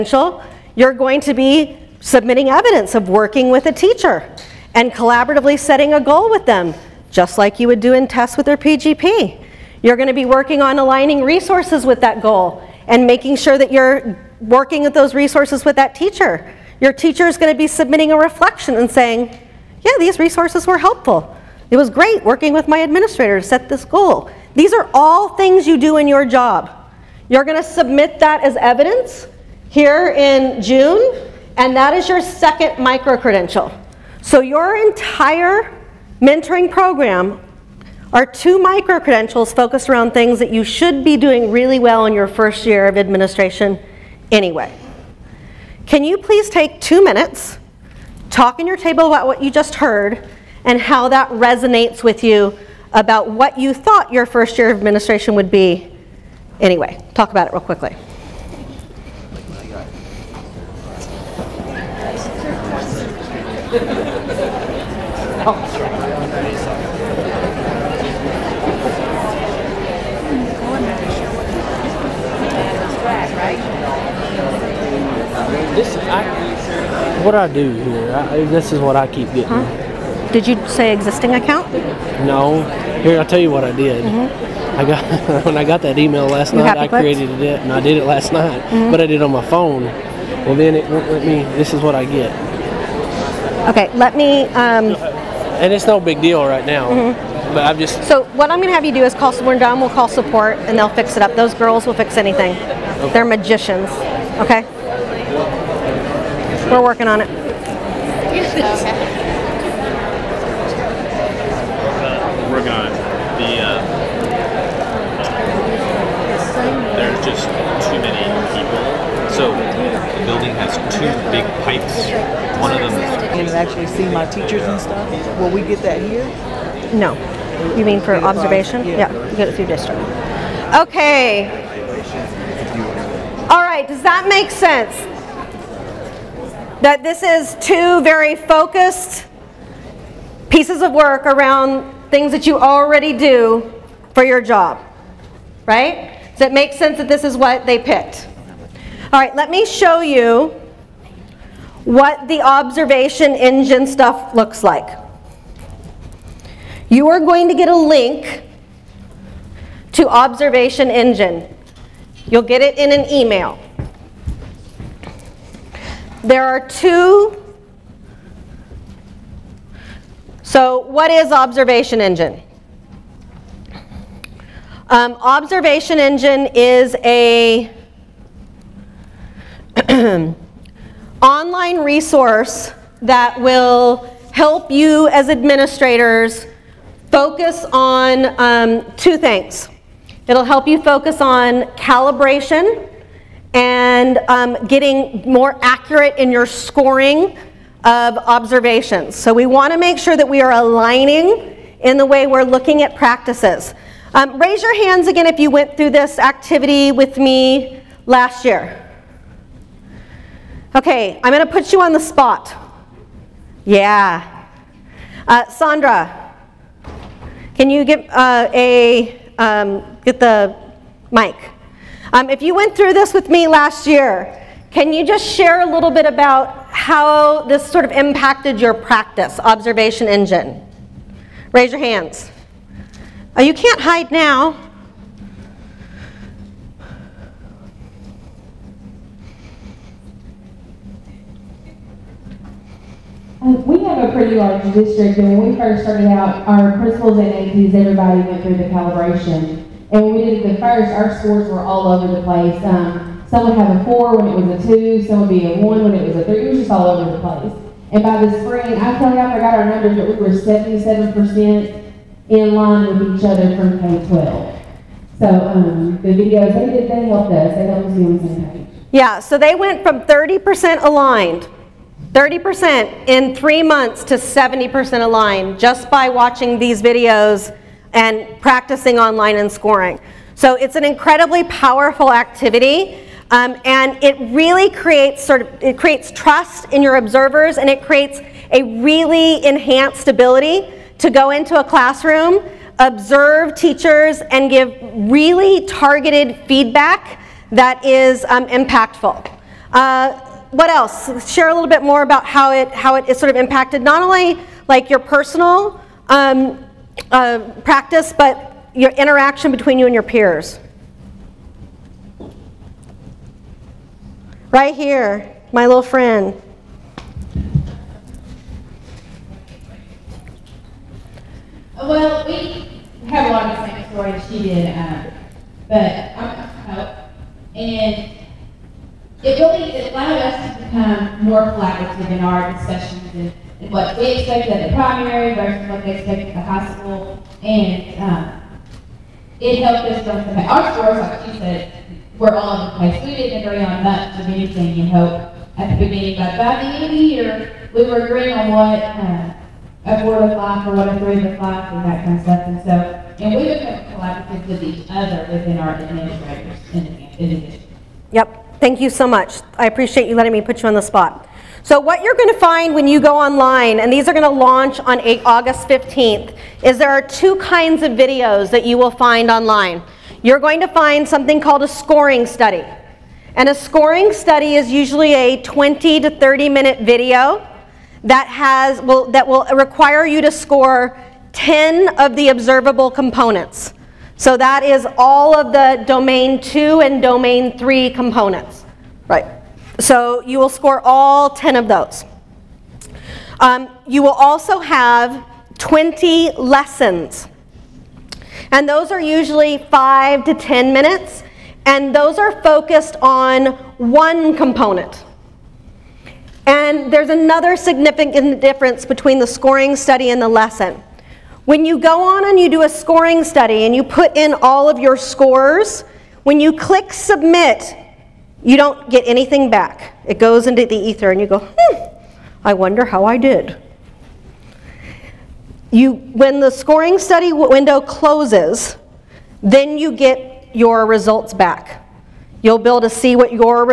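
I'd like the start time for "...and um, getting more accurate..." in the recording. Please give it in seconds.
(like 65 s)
193 s.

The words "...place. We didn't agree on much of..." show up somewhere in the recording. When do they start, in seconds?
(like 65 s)
342 s.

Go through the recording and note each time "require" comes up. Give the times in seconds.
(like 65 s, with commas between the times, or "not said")
379 s.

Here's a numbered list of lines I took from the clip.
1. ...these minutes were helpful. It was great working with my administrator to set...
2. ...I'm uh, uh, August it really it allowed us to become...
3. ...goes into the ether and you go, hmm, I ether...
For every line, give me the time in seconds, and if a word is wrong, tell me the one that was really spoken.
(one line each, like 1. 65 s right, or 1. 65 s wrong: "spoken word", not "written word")
1. 19 s wrong: "resources", not "minutes"
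2. 325 s wrong: "And", not "August"
3. 420 s wrong: "wonder", not "ether".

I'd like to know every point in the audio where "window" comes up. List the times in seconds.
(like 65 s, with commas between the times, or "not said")
427 s.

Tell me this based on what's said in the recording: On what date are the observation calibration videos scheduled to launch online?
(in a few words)
August 15th.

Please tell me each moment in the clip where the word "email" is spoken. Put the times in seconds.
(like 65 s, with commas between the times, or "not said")
85 s, 163 s.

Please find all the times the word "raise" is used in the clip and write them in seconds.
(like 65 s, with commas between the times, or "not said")
204 s, 231 s.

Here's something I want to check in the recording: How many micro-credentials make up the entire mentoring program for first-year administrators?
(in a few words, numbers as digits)
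2.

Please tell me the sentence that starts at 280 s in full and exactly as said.
So it's an incredibly powerful activity.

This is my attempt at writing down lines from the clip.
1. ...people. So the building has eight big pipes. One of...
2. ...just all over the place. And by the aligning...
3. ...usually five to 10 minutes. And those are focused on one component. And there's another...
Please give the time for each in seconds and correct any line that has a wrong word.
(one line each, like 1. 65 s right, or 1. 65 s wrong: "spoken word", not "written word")
1. 118 s wrong: "two", not "eight"
2. 256 s wrong: "spring", not "aligning"
3. 399 s right.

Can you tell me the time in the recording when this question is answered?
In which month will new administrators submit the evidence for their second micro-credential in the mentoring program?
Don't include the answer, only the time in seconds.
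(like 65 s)
30 s.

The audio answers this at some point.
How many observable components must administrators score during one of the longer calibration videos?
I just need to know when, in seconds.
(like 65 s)
381 s.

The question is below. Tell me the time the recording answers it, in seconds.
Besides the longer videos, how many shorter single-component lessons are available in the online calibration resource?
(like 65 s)
395 s.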